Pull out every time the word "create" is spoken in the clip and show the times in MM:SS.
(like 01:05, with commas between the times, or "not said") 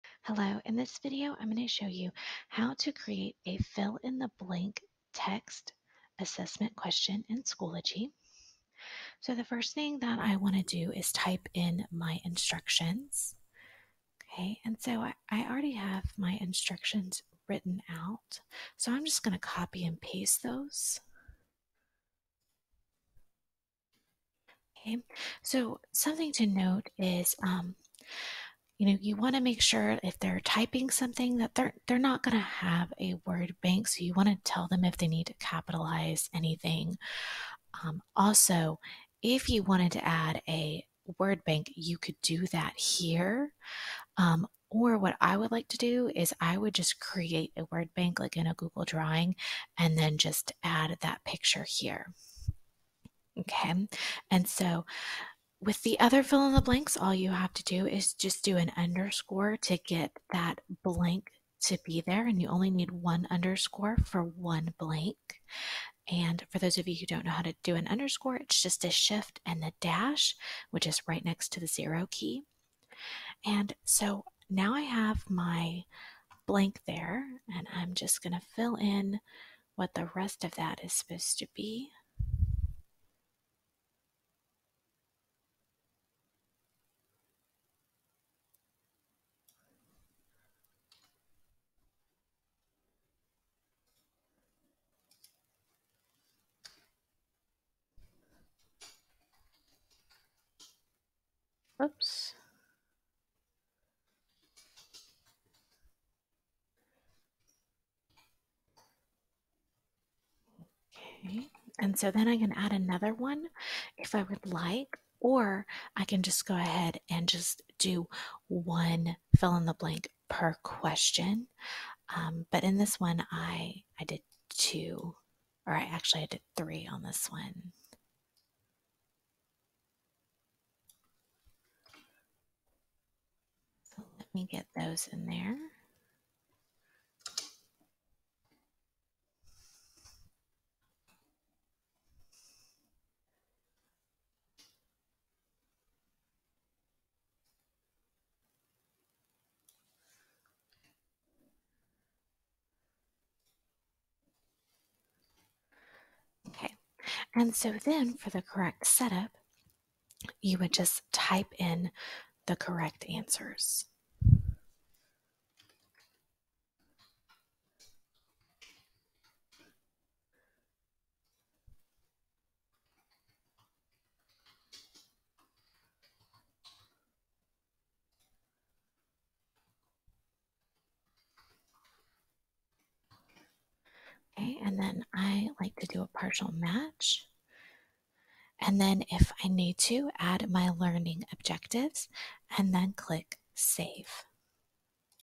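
00:02, 00:46.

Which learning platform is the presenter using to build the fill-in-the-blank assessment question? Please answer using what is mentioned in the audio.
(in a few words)
Schoology.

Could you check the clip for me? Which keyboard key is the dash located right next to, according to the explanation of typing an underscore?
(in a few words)
the zero key.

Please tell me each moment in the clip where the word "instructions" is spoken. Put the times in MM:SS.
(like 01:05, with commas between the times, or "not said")
00:12, 00:16.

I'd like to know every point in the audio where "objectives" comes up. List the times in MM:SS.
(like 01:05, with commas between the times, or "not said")
03:11.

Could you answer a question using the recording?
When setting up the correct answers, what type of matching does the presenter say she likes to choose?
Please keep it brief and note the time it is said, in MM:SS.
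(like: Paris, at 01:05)
partial match, at 03:06.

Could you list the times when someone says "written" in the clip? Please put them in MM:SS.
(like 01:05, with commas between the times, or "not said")
00:17.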